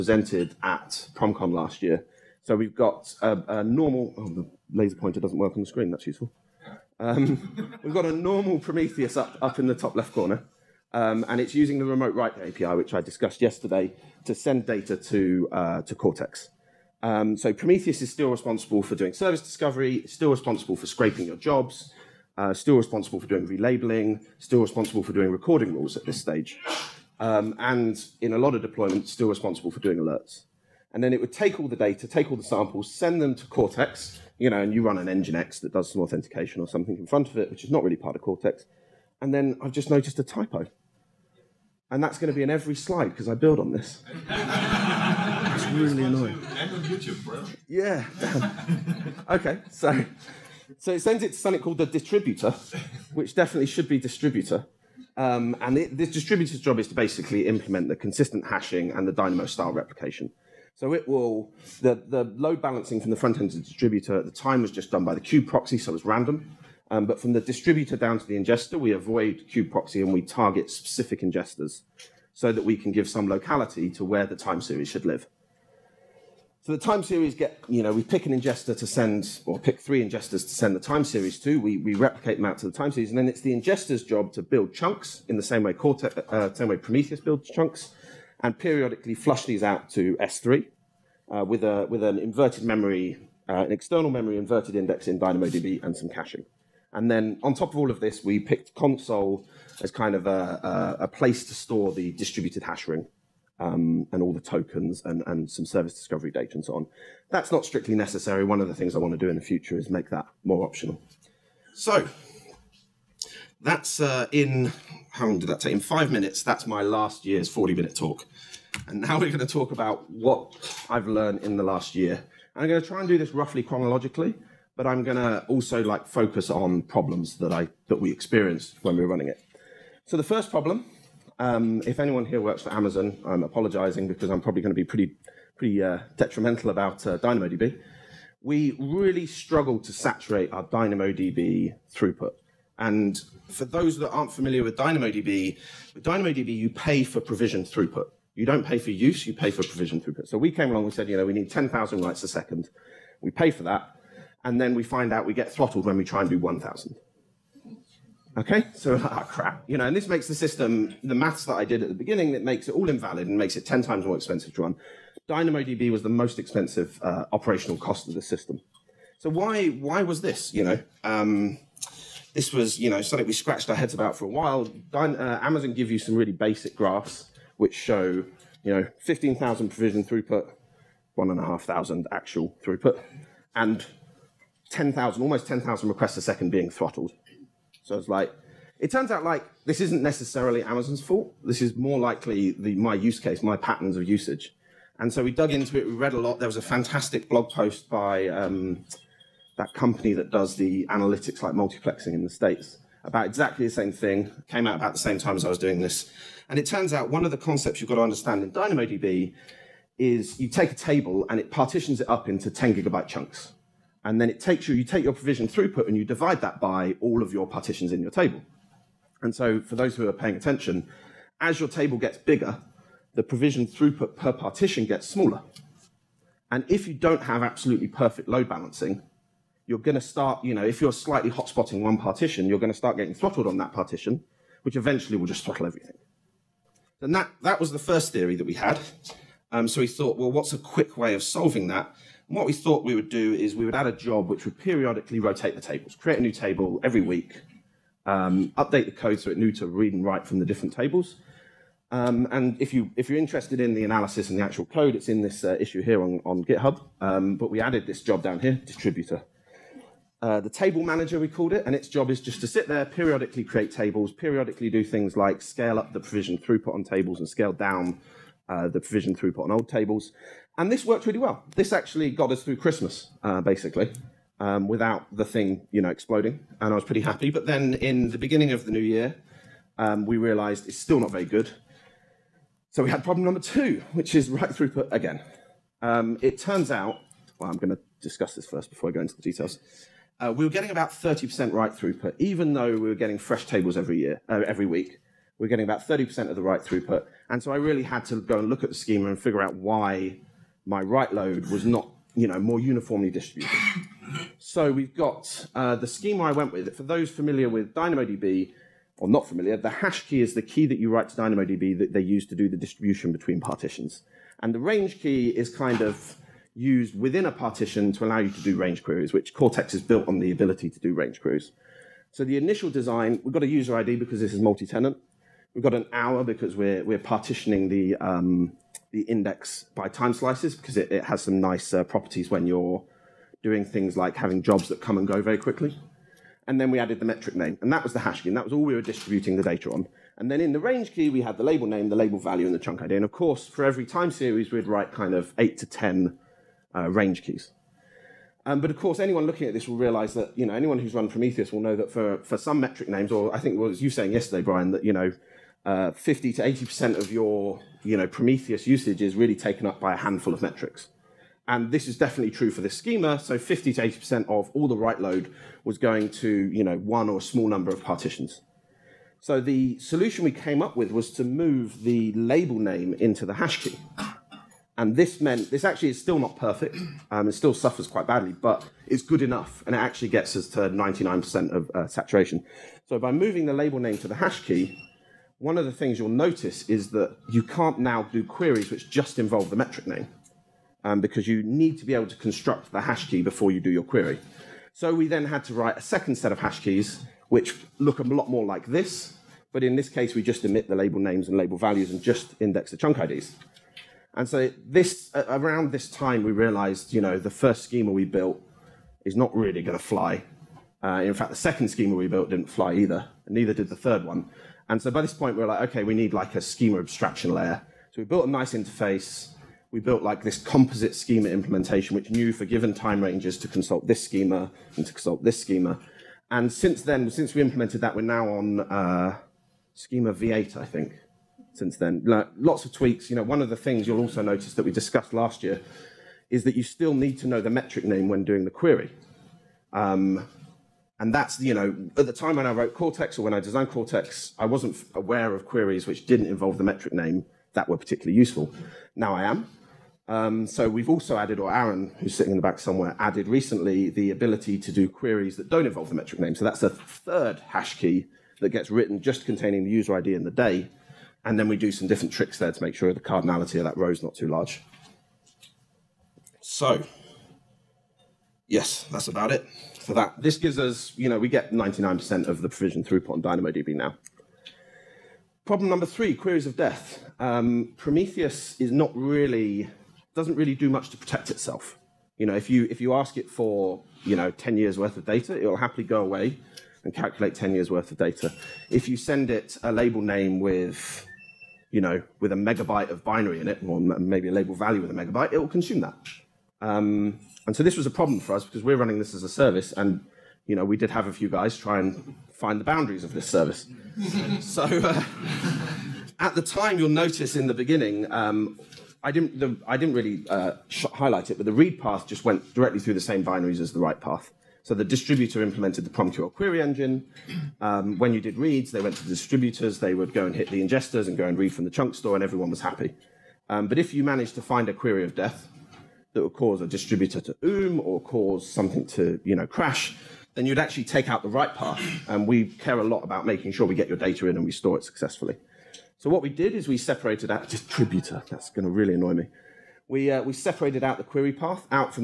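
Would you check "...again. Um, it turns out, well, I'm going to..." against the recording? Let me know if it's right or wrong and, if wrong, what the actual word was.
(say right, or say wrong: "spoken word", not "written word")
right.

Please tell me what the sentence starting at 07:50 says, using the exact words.
This gives us, you know, we get 99% of the provision throughput on DynamoDB now.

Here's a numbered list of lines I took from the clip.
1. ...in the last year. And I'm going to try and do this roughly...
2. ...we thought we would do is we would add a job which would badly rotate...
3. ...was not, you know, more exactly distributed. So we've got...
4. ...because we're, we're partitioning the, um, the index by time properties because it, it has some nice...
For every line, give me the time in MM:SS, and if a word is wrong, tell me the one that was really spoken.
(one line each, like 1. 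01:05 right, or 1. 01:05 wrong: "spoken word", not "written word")
1. 02:01 right
2. 04:02 wrong: "periodically", not "badly"
3. 05:01 wrong: "uniformly", not "exactly"
4. 05:26 wrong: "slices", not "properties".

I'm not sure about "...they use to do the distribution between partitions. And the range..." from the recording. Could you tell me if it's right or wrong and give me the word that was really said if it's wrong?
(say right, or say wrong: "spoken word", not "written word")
right.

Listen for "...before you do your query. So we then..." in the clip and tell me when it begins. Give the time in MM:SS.
06:33.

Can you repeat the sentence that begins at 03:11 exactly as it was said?
This is more likely the, my use case, my patterns of usage.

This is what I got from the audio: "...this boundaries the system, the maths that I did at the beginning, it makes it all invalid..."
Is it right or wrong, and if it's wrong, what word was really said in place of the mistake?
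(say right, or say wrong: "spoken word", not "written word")
wrong: "makes", not "boundaries".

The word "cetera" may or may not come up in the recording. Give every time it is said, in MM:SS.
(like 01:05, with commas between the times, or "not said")
not said.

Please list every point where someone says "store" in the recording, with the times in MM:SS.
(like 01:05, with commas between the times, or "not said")
01:41, 08:41, 08:54.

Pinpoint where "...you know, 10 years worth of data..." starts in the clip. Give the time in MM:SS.
08:04.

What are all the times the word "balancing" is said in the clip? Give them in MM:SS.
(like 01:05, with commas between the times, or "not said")
01:02, 03:48.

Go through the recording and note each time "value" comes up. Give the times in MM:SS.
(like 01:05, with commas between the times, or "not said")
05:42, 06:41, 08:14.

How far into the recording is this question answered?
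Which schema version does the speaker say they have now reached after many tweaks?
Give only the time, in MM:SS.
07:09.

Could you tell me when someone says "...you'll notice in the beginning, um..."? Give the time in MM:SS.
08:26.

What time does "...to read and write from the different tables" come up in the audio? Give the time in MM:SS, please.
04:09.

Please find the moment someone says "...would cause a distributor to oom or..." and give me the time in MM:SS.
08:46.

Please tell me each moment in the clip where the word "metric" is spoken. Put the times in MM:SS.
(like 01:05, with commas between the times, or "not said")
05:37, 05:52, 06:00, 06:29, 07:17, 07:26, 07:35.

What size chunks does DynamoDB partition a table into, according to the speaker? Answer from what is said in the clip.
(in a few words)
10 gigabytes.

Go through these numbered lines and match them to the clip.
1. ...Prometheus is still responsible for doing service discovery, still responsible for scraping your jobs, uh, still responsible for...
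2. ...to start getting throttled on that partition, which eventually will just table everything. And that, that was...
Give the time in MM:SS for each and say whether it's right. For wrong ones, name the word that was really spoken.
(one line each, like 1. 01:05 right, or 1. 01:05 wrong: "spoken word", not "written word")
1. 00:17 right
2. 03:52 wrong: "throttle", not "table".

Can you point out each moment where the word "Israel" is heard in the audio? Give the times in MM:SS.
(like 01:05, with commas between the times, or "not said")
not said.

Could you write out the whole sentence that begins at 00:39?
And then I've just noticed a typo.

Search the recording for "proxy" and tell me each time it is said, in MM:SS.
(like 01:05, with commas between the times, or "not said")
01:05, 01:09.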